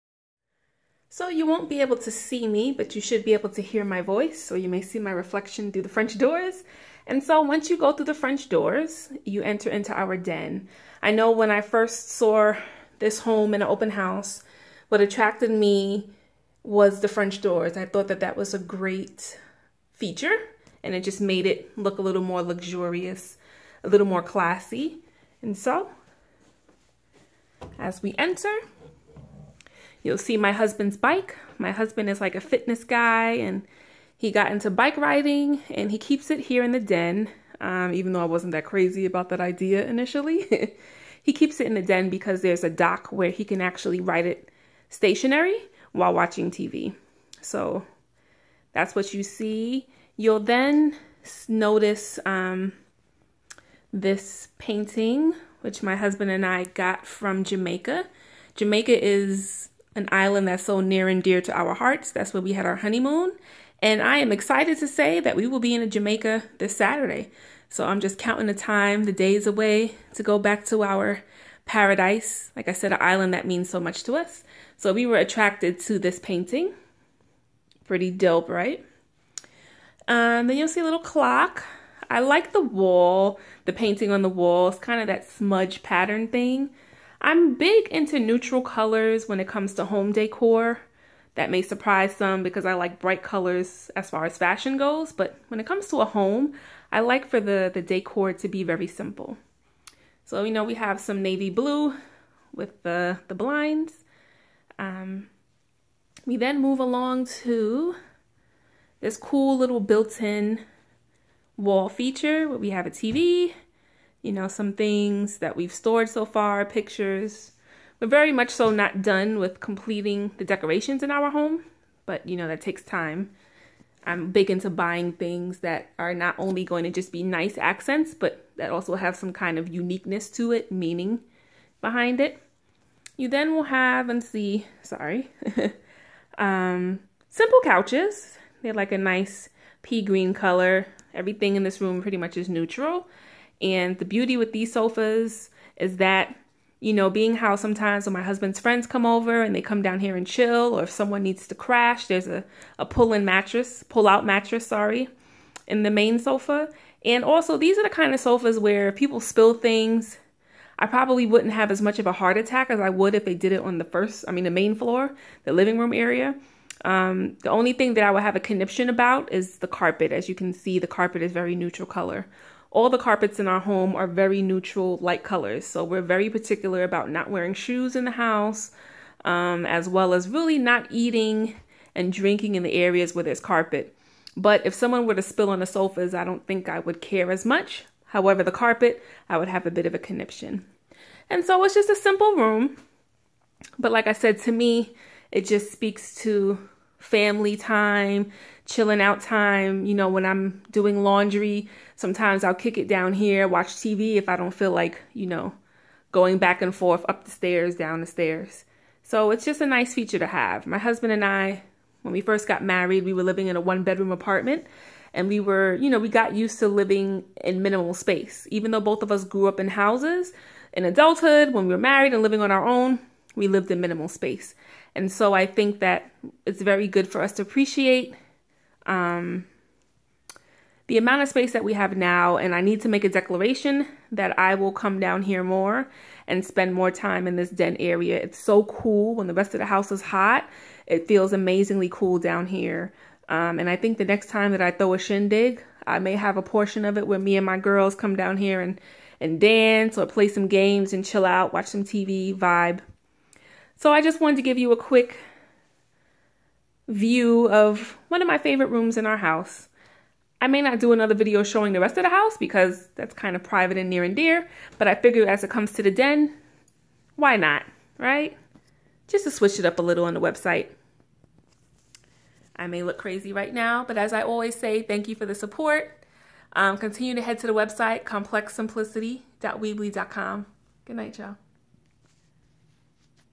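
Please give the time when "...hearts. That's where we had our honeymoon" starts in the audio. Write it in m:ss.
1:01.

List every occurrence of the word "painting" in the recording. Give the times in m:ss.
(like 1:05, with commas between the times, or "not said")
0:54, 1:16, 1:23.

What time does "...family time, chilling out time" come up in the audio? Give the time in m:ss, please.
3:17.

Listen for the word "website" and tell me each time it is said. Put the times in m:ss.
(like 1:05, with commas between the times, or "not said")
4:30, 4:37.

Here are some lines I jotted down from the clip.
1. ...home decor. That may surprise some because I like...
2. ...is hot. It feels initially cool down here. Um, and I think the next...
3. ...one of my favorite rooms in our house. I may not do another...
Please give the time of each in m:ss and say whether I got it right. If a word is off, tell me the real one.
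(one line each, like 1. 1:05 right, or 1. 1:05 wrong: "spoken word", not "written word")
1. 1:29 right
2. 3:59 wrong: "amazingly", not "initially"
3. 4:18 right.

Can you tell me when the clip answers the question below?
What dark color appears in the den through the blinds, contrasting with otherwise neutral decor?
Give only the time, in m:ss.
1:41.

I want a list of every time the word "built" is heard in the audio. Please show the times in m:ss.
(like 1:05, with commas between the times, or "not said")
1:49.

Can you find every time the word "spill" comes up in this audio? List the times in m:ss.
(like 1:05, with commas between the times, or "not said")
2:39, 3:05.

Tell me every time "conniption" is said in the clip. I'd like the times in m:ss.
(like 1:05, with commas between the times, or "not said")
2:48, 3:09.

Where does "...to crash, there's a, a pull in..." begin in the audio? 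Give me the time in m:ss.
2:31.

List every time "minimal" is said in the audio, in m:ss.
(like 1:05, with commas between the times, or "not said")
3:37, 3:43.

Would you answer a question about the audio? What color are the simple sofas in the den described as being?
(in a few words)
Pea green.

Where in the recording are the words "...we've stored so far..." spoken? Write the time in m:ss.
1:55.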